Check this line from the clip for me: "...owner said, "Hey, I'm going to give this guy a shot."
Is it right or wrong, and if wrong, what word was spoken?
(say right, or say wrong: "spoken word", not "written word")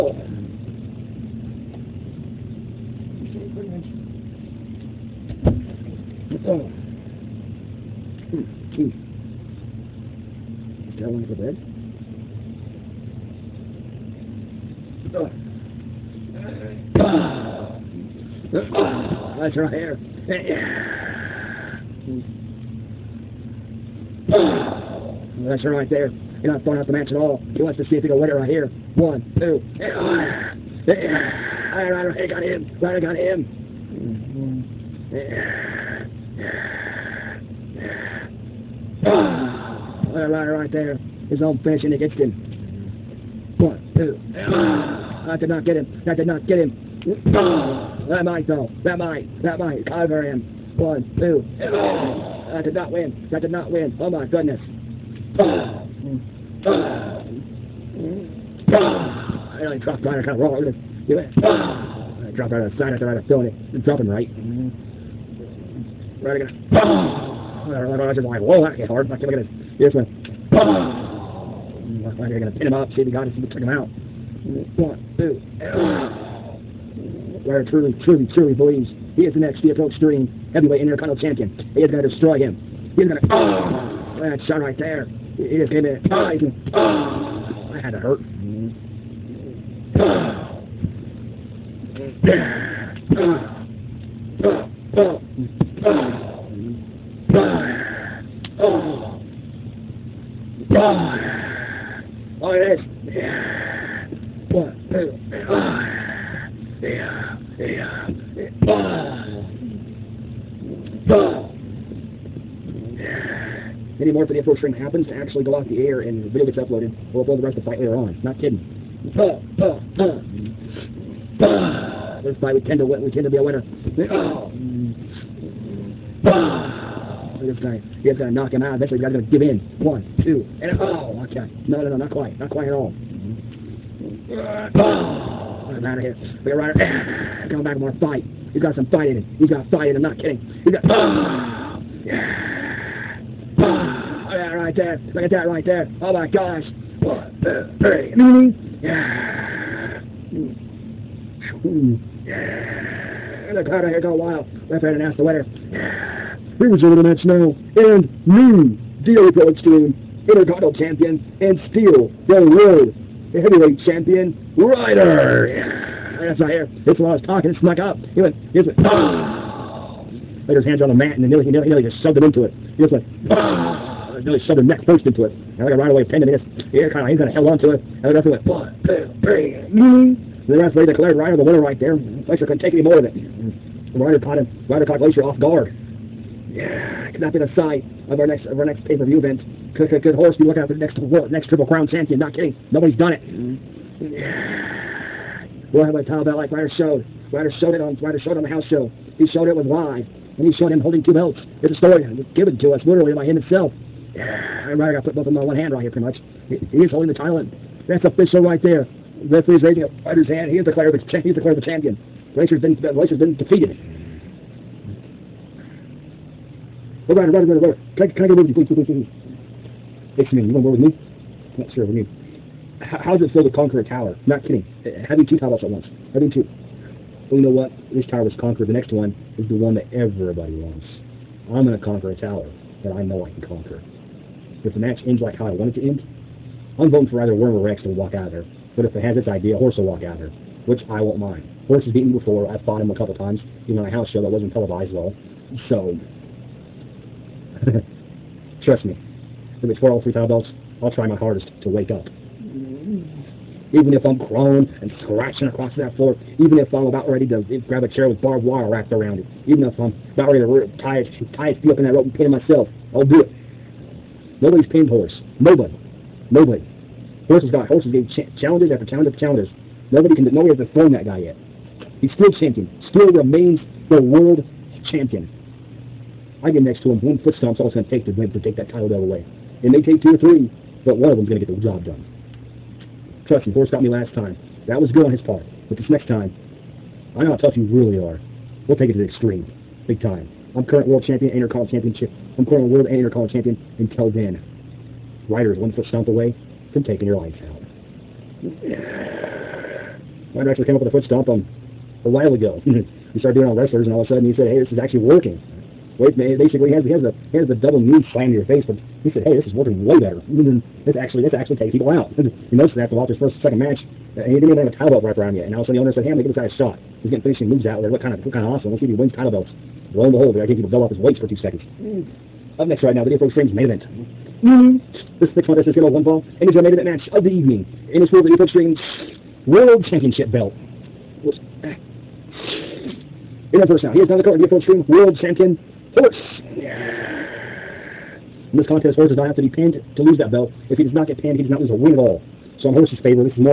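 right.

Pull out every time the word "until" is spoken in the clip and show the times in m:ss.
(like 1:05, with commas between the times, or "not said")
4:53.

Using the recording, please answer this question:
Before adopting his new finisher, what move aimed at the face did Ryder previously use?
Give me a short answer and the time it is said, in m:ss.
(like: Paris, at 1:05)
double knee slam, at 5:07.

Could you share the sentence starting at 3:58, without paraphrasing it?
But if it has its idea, Horse will walk out of there, which I won't mind.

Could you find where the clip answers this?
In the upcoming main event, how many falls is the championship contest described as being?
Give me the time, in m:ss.
5:25.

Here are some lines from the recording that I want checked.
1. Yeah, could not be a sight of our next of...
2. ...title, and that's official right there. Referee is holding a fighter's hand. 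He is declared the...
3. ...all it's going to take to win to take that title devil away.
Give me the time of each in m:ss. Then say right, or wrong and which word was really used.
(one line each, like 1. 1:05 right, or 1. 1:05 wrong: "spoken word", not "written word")
1. 3:06 right
2. 3:27 wrong: "raising", not "holding"
3. 4:37 right.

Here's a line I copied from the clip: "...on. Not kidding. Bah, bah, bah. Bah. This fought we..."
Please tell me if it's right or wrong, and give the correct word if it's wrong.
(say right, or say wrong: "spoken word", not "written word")
wrong: "fight", not "fought".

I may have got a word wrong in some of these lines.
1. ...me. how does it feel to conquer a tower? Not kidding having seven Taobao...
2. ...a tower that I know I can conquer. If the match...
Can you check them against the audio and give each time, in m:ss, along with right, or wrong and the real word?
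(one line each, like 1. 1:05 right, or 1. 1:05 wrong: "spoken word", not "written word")
1. 3:41 wrong: "two", not "seven"
2. 3:52 right.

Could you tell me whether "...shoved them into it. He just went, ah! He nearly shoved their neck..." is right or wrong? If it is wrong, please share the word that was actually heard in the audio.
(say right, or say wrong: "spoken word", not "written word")
right.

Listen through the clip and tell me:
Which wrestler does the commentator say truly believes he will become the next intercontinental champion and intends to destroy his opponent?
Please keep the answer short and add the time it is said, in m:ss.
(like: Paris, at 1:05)
Guerrero, at 1:17.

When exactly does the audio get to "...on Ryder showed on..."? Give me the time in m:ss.
3:17.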